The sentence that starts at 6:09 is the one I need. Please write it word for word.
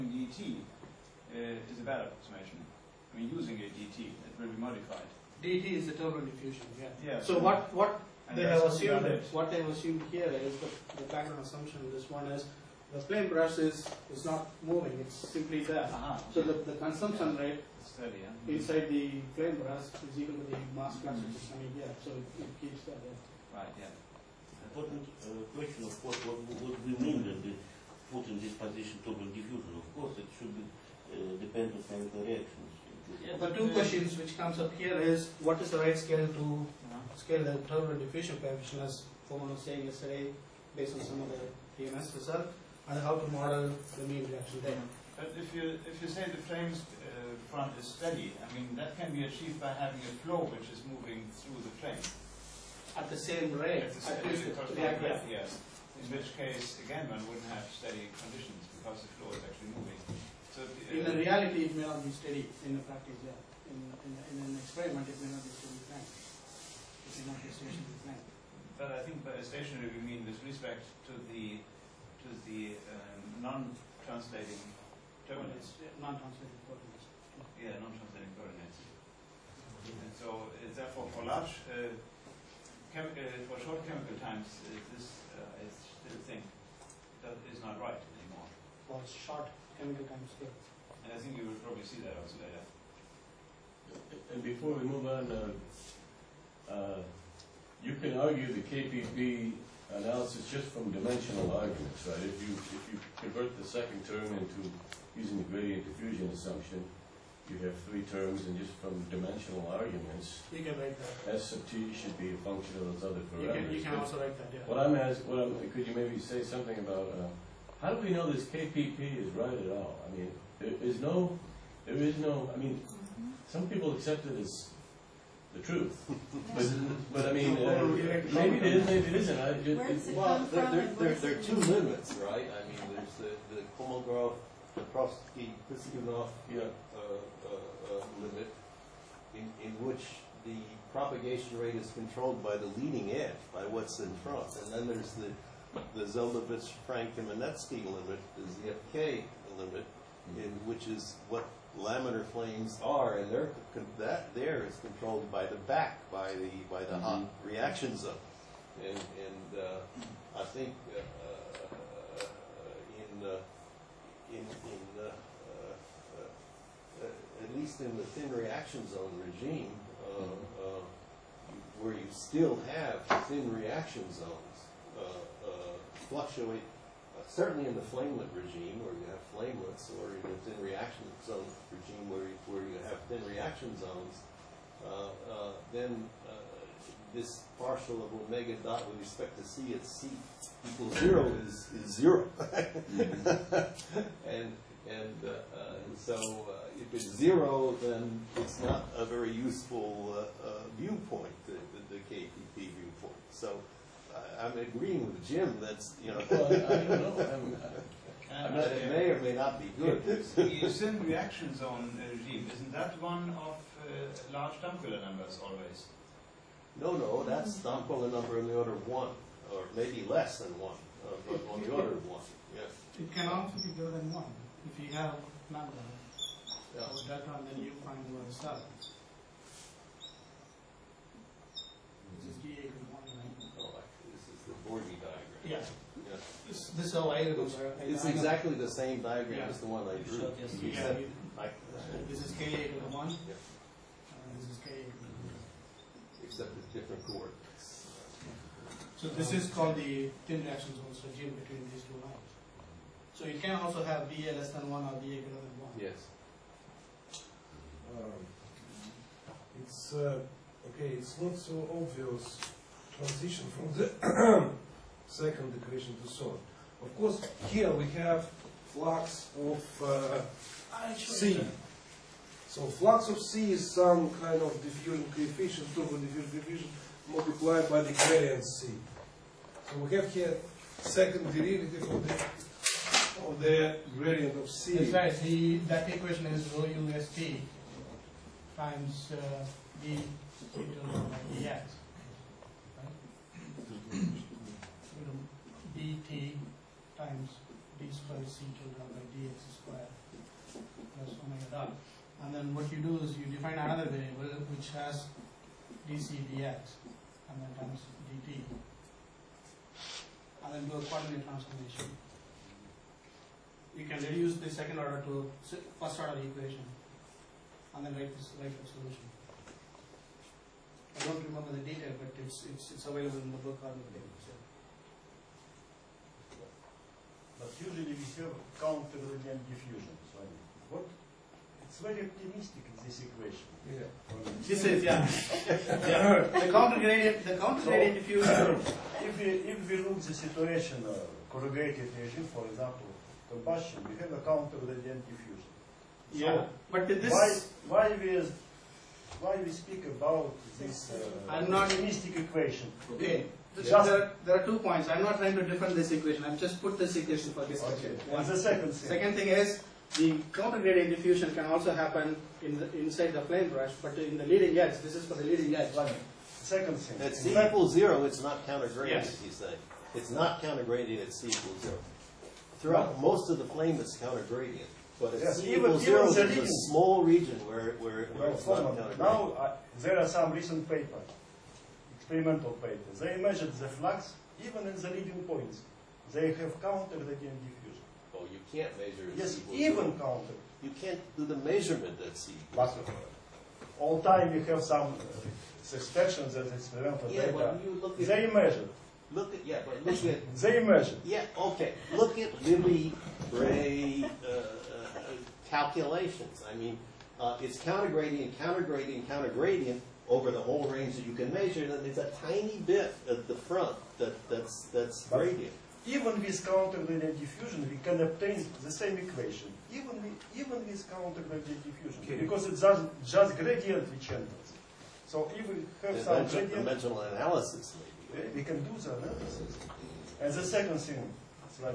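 he's It's not counter-gradient at C equals zero.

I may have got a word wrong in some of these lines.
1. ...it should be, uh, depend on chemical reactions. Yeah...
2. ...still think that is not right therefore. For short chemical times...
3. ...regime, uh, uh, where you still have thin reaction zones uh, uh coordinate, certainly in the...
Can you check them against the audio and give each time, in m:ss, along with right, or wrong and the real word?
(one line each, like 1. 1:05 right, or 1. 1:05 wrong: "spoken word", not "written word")
1. 0:30 right
2. 1:25 wrong: "anymore", not "therefore"
3. 2:49 wrong: "fluctuate", not "coordinate".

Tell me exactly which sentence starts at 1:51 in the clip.
S sub t should be a function of those other You parameters.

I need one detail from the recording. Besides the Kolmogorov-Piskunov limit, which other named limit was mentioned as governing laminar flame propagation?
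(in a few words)
Zeldovich Frank Kamenetsky.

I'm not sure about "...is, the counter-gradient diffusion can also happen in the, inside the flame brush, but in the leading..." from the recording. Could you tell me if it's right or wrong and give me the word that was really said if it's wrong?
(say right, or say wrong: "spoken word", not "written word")
right.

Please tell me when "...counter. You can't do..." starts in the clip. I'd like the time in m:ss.
6:29.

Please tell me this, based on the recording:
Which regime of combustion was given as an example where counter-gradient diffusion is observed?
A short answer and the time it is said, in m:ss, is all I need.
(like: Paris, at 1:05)
corrugated regime, at 5:41.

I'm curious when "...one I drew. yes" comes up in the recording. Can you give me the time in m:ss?
3:59.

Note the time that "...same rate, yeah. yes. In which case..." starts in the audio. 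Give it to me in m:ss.
0:54.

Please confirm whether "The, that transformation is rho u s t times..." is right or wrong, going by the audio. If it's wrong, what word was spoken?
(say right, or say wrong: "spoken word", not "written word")
wrong: "equation", not "transformation".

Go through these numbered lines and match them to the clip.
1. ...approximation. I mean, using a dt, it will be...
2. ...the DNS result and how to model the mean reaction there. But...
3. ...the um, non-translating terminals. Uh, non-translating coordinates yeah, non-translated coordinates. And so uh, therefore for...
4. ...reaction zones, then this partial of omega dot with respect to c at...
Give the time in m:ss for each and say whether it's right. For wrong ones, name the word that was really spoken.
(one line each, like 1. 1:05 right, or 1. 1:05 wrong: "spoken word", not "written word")
1. 0:02 right
2. 0:41 right
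3. 1:12 right
4. 3:03 right.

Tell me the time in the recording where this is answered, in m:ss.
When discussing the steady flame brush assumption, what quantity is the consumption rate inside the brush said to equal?
0:20.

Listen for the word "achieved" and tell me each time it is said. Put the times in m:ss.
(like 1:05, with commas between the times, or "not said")
0:49.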